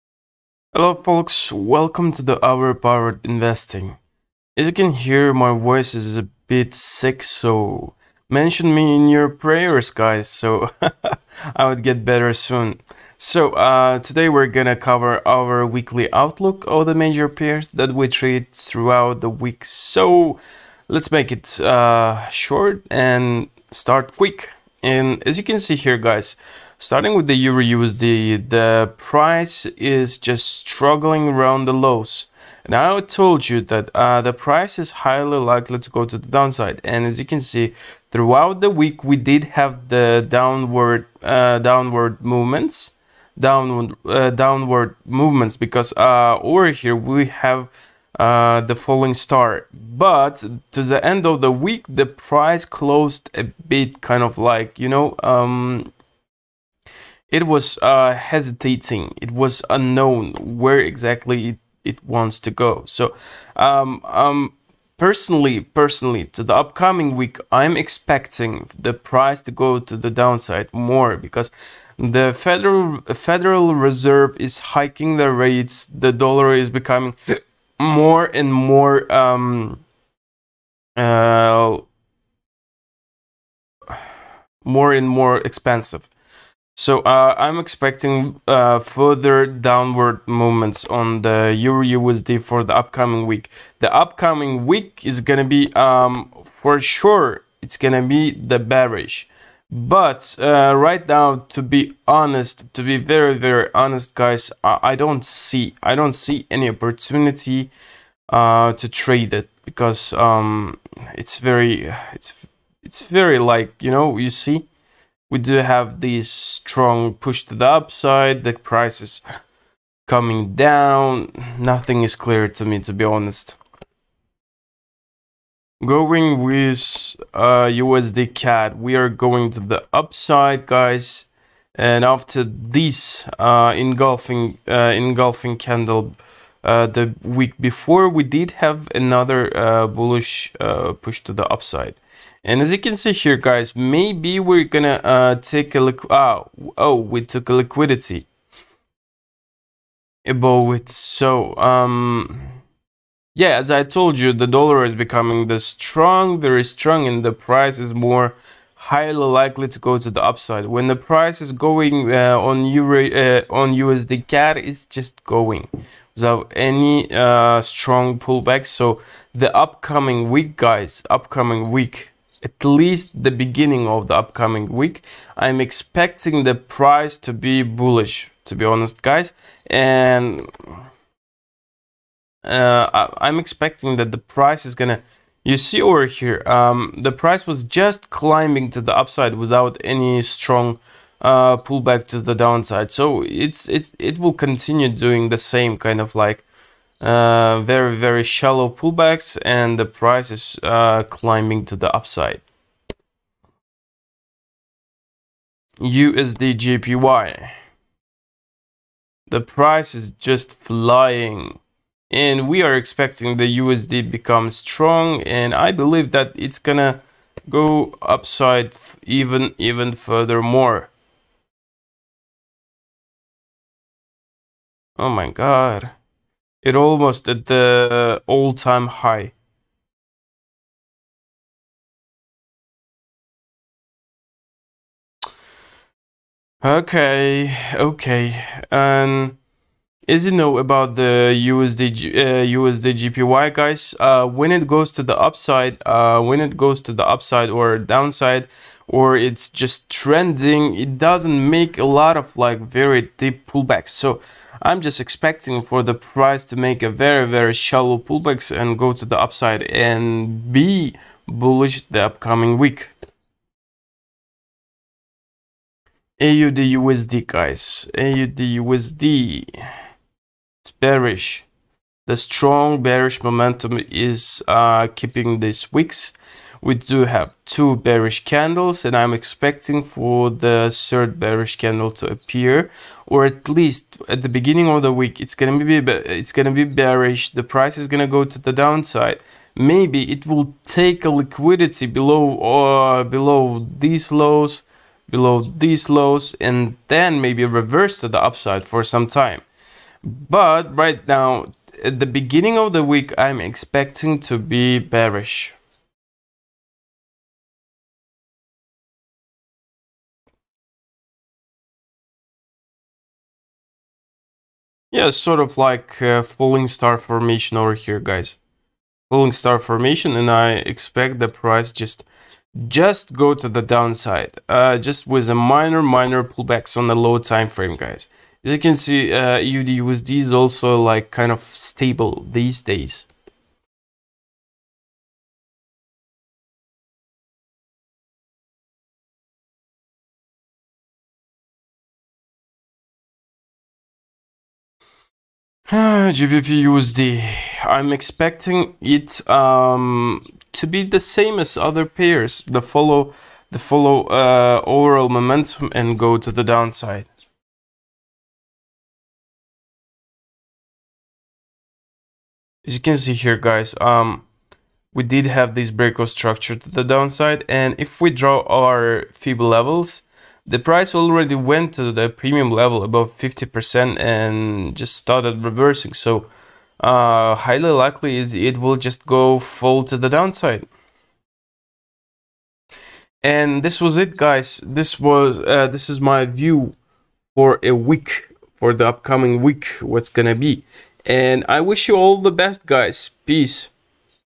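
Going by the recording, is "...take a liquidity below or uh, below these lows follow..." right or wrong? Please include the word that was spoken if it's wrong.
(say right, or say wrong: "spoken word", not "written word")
wrong: "below", not "follow".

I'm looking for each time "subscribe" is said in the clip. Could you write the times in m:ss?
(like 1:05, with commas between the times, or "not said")
not said.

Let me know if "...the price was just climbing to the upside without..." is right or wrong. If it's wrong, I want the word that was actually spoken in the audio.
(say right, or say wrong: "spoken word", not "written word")
right.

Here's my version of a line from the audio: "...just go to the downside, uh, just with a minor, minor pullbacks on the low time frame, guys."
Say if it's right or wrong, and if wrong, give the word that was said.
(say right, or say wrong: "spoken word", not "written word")
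right.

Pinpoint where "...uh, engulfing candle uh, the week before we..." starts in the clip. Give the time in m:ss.
2:14.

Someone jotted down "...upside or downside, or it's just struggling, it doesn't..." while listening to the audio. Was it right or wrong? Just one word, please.
wrong.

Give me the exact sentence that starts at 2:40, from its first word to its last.
When the price is going uh, on Euro, uh, on USD CAD, it's just going without any uh, strong pullback.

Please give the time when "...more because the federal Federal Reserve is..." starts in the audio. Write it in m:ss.
1:10.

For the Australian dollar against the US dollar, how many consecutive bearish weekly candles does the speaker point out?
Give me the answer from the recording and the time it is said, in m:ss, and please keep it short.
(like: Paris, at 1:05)
2, at 4:37.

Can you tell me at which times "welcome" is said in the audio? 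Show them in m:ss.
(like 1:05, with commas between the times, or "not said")
0:01.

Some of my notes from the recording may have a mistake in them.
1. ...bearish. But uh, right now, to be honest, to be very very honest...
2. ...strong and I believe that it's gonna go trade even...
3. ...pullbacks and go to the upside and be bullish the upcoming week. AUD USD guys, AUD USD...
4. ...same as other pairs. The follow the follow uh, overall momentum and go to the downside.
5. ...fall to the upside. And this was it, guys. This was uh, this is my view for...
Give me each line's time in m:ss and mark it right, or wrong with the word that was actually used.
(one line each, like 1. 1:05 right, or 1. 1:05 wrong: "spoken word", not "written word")
1. 1:38 right
2. 3:34 wrong: "upside", not "trade"
3. 4:17 right
4. 5:50 right
5. 6:19 wrong: "downside", not "upside".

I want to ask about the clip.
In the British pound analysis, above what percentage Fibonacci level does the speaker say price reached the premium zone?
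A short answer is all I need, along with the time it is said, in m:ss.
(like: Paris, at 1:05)
50%, at 6:13.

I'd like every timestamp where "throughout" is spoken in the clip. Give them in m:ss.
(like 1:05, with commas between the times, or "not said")
0:18, 0:38.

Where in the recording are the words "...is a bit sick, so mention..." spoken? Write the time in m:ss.
0:05.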